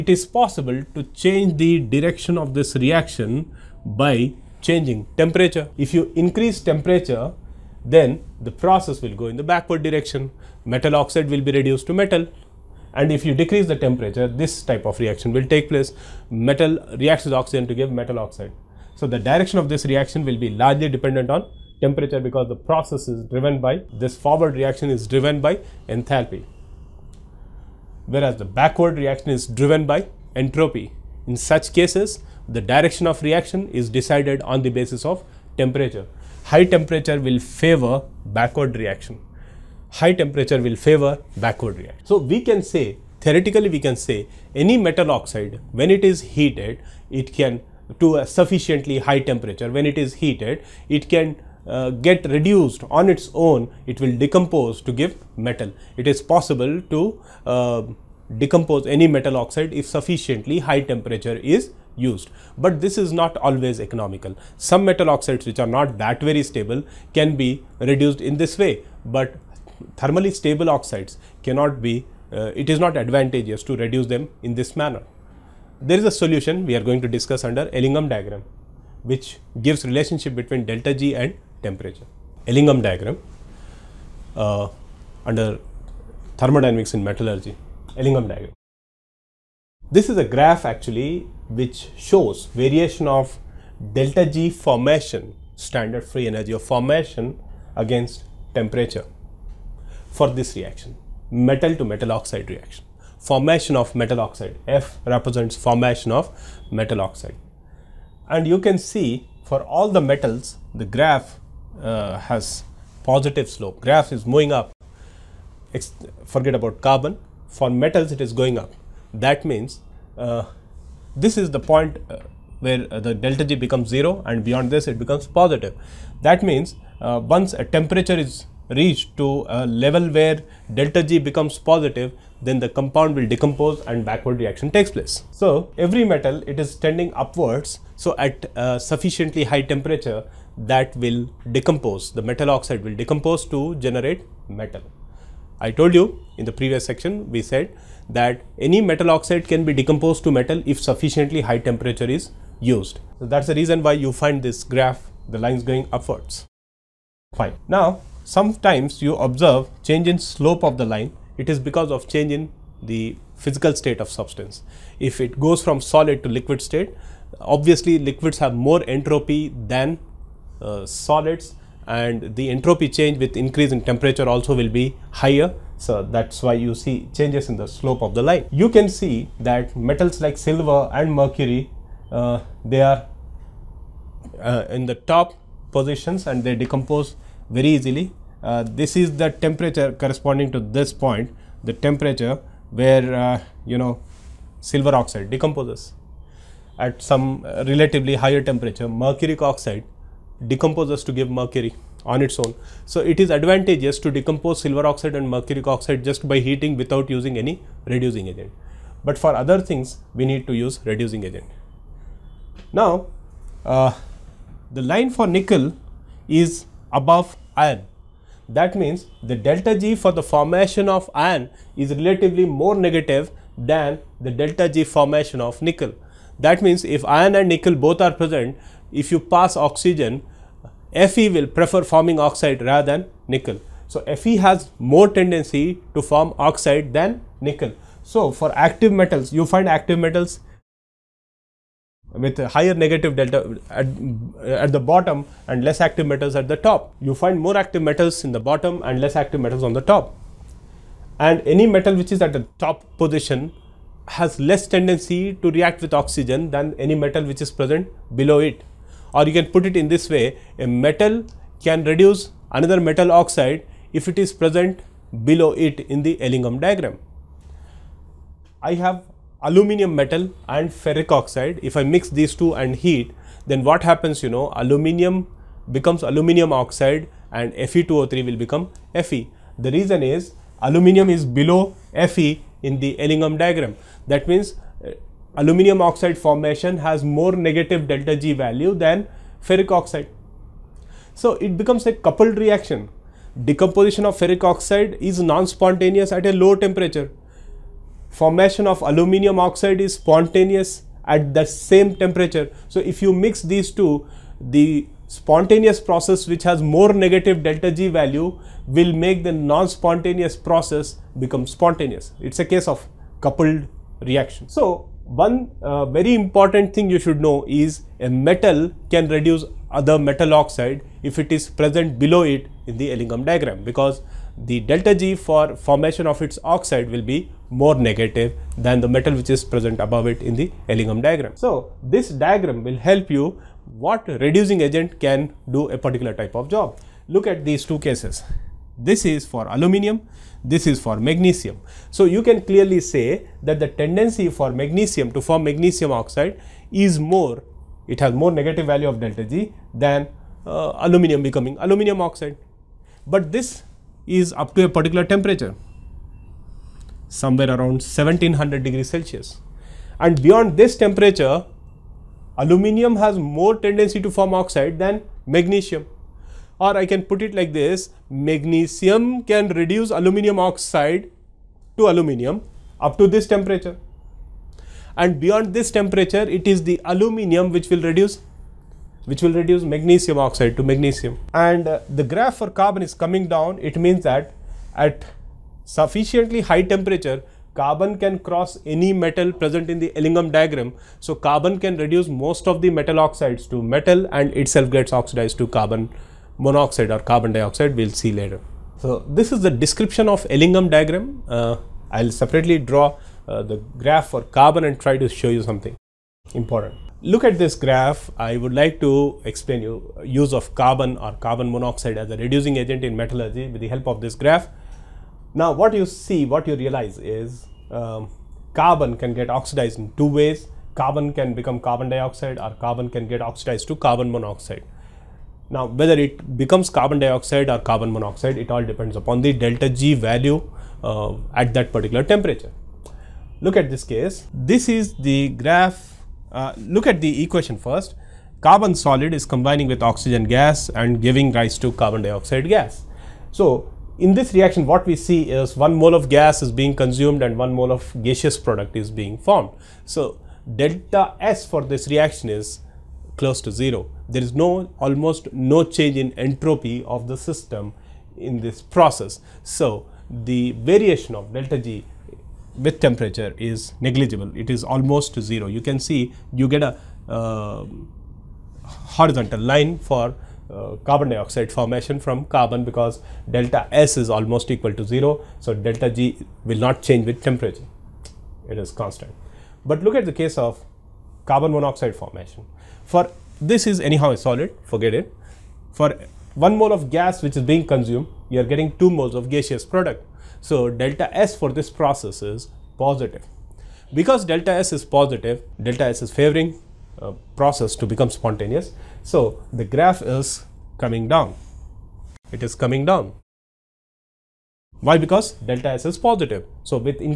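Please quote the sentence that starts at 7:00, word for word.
Carbon can become carbon dioxide or carbon can get oxidized to carbon monoxide.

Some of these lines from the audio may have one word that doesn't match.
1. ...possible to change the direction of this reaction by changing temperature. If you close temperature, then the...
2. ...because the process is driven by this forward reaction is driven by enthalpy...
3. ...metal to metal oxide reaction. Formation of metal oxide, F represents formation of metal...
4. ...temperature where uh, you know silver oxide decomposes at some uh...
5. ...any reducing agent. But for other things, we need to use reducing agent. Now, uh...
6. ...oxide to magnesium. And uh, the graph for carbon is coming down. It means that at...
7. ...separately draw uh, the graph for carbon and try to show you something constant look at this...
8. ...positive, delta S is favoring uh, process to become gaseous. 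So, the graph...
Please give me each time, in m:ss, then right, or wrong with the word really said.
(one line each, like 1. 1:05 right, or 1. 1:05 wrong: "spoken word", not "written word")
1. 0:00 wrong: "increase", not "close"
2. 0:22 right
3. 1:41 right
4. 3:11 right
5. 3:27 right
6. 6:20 right
7. 6:42 wrong: "important", not "constant"
8. 8:14 wrong: "spontaneous", not "gaseous".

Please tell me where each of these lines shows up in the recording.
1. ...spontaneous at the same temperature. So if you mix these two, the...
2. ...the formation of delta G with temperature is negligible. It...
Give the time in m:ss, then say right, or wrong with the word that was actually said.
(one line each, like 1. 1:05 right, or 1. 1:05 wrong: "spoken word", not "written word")
1. 4:59 right
2. 7:40 wrong: "variation", not "formation".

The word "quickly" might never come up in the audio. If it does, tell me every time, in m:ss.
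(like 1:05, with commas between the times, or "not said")
not said.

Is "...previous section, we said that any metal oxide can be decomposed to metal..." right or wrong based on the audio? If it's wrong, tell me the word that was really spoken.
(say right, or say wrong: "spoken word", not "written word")
right.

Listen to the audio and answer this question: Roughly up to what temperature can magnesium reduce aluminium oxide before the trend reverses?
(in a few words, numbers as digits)
1700 degrees Celsius.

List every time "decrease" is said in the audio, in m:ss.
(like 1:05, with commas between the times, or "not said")
0:13.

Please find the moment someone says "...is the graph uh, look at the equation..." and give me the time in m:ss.
7:14.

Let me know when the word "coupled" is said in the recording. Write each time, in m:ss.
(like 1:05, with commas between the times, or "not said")
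4:51, 5:13.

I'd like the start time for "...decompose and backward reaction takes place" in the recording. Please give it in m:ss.
2:13.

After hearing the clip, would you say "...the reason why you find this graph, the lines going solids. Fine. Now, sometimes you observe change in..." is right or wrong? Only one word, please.
wrong.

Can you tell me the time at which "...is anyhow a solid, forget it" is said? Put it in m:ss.
8:03.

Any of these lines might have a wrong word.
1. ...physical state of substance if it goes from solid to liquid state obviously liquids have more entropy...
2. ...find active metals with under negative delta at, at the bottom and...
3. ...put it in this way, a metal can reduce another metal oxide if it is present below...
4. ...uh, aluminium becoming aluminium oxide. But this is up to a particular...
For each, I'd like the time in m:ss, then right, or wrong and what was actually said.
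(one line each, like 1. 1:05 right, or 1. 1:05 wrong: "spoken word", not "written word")
1. 2:43 right
2. 3:59 wrong: "higher", not "under"
3. 4:19 right
4. 5:50 right.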